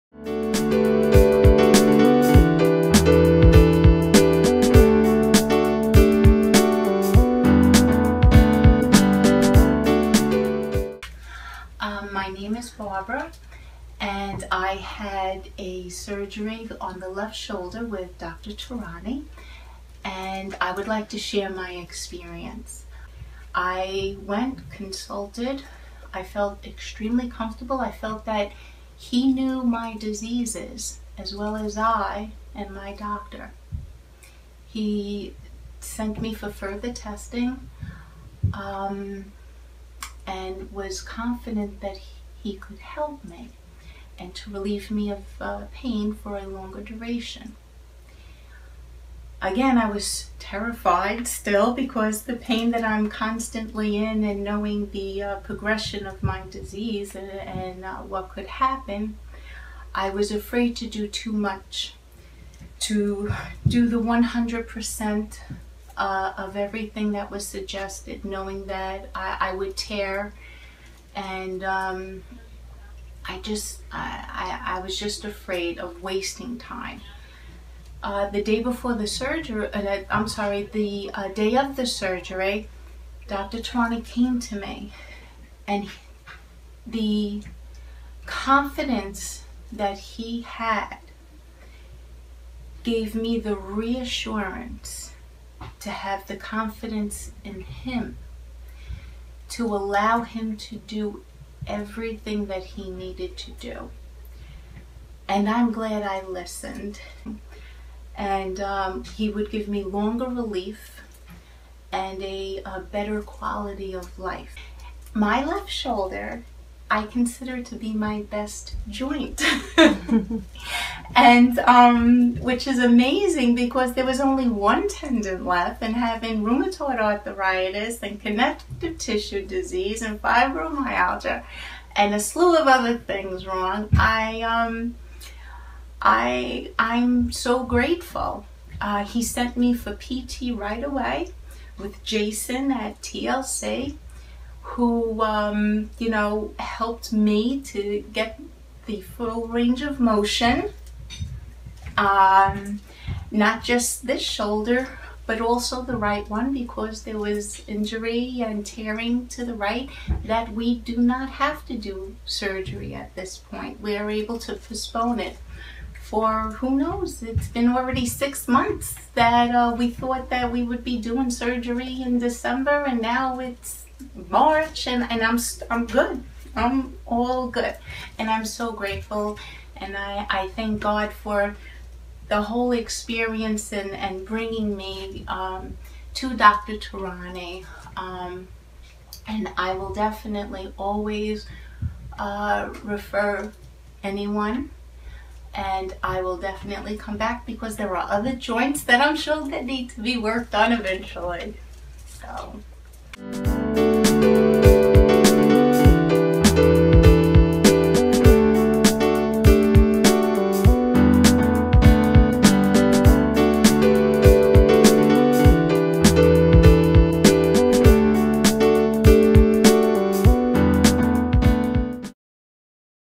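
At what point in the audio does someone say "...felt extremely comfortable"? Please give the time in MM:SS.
00:26.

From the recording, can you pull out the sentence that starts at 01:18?
Uh, the day before the surgery, uh, I'm sorry, the uh, day of the surgery, Dr.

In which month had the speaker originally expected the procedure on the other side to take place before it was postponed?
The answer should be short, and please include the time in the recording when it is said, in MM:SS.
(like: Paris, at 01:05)
December, at 02:52.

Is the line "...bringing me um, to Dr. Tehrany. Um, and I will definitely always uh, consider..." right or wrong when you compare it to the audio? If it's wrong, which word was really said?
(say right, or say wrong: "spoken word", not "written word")
wrong: "refer", not "consider".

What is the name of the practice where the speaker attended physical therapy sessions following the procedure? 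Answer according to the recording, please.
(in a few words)
TLC.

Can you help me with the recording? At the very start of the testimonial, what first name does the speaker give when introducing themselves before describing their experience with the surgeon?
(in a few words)
Barbara.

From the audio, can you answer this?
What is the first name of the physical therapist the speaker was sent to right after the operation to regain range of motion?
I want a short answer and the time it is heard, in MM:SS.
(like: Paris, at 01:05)
Jason, at 02:22.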